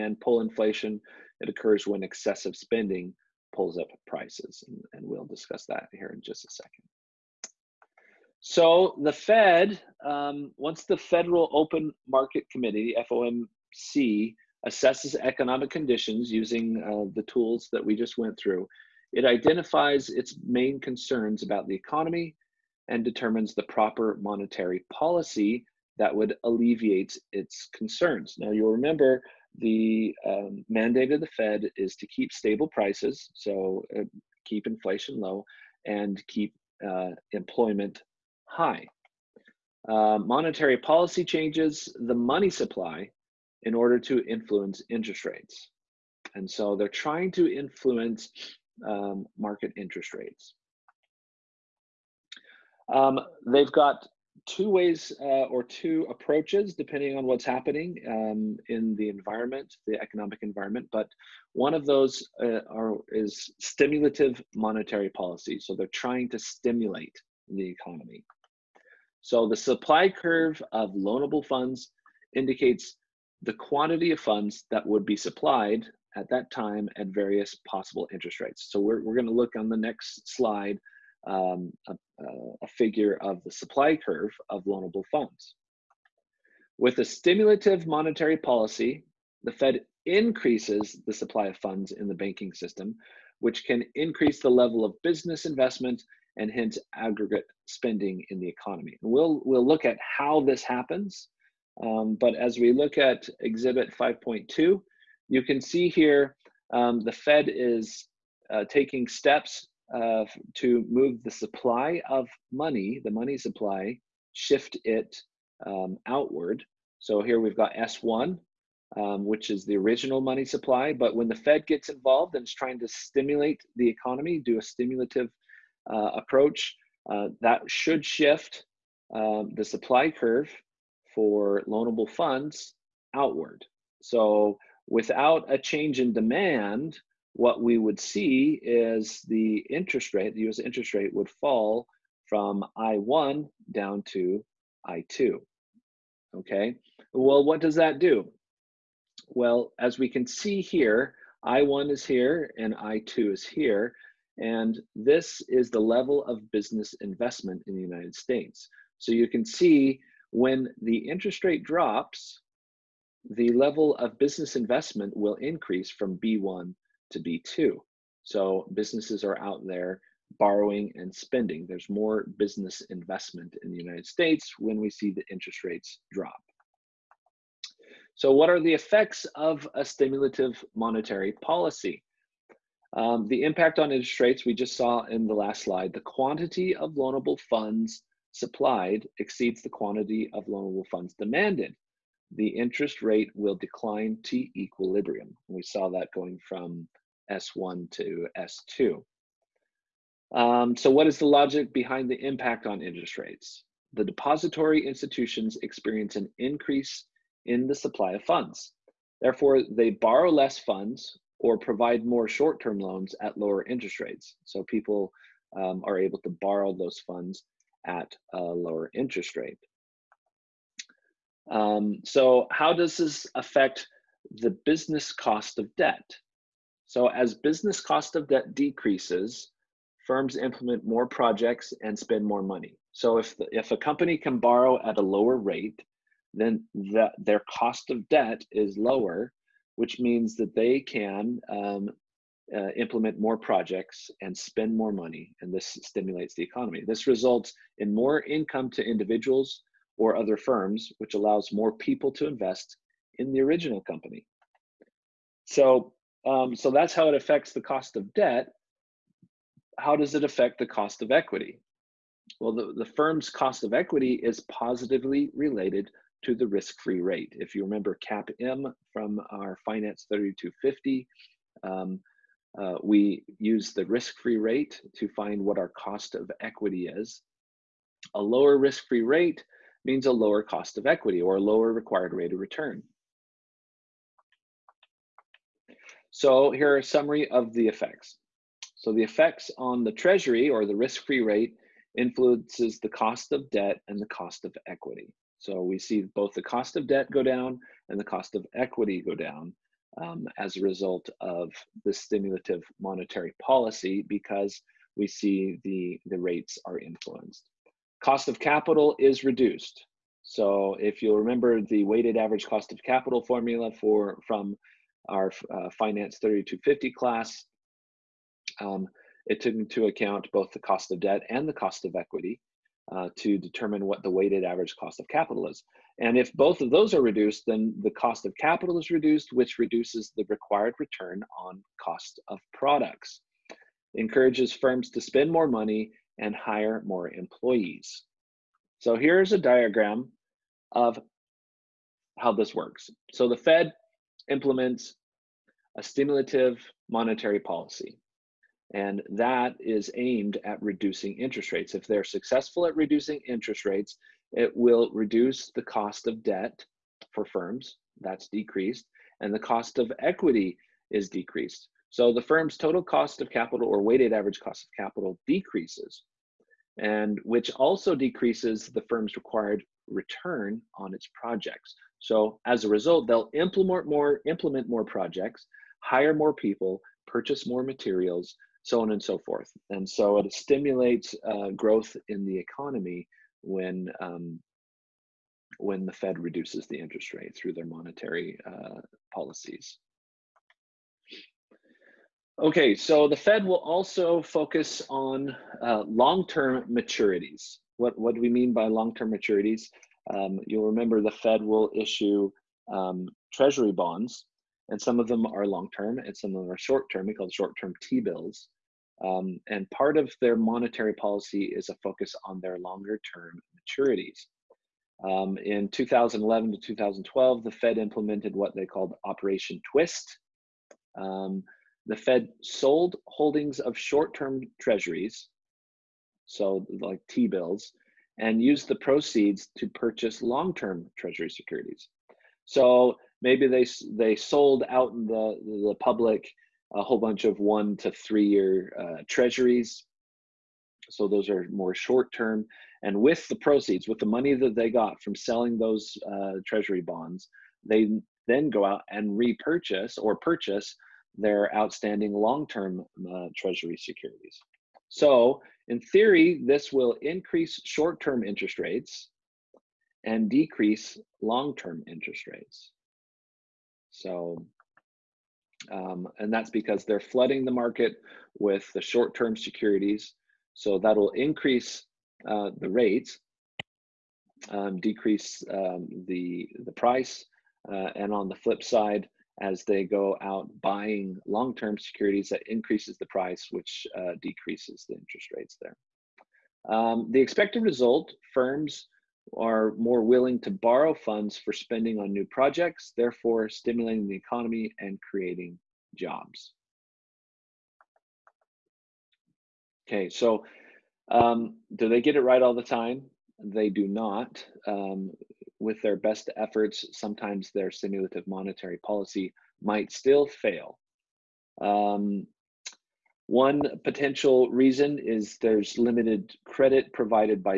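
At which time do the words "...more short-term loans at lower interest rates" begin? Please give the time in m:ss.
3:32.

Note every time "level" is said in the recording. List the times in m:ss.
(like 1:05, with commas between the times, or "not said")
1:34, 2:35, 2:43.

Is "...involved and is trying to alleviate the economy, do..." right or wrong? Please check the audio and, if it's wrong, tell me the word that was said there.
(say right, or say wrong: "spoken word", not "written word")
wrong: "stimulate", not "alleviate".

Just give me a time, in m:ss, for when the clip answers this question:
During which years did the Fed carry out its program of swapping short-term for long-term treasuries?
6:55.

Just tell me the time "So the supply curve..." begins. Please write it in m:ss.
1:09.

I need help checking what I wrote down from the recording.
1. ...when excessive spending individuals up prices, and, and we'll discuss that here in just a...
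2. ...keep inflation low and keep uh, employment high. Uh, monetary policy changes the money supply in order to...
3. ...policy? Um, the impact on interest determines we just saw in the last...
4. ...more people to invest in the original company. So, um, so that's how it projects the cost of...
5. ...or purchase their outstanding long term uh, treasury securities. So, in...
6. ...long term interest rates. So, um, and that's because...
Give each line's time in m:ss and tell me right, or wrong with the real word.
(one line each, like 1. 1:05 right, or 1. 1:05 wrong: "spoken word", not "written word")
1. 0:01 wrong: "pulls", not "individuals"
2. 0:34 right
3. 3:01 wrong: "rates", not "determines"
4. 4:11 wrong: "affects", not "projects"
5. 7:29 right
6. 7:41 right.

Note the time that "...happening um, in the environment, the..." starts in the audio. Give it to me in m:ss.
0:57.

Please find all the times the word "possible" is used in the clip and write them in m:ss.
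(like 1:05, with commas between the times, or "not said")
1:17.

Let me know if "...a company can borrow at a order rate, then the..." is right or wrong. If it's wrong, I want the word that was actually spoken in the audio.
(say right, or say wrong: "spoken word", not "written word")
wrong: "lower", not "order".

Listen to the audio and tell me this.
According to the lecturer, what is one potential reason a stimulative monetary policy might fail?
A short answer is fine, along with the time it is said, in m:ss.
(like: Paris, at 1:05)
Limited credit provided, at 8:35.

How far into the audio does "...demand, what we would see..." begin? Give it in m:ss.
2:16.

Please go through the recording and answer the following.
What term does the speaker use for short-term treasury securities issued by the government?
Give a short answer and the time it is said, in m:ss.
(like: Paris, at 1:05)
T-bills, at 6:47.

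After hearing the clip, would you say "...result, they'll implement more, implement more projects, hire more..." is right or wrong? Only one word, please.
right.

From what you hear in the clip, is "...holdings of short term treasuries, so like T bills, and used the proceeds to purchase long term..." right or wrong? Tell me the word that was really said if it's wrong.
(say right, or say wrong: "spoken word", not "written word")
right.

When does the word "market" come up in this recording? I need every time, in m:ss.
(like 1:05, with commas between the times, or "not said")
0:12, 0:49, 7:47.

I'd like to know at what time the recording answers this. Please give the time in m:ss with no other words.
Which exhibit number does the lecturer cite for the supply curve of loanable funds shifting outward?
1:43.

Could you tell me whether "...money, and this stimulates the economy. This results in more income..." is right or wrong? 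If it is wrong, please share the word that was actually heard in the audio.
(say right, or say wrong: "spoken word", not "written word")
right.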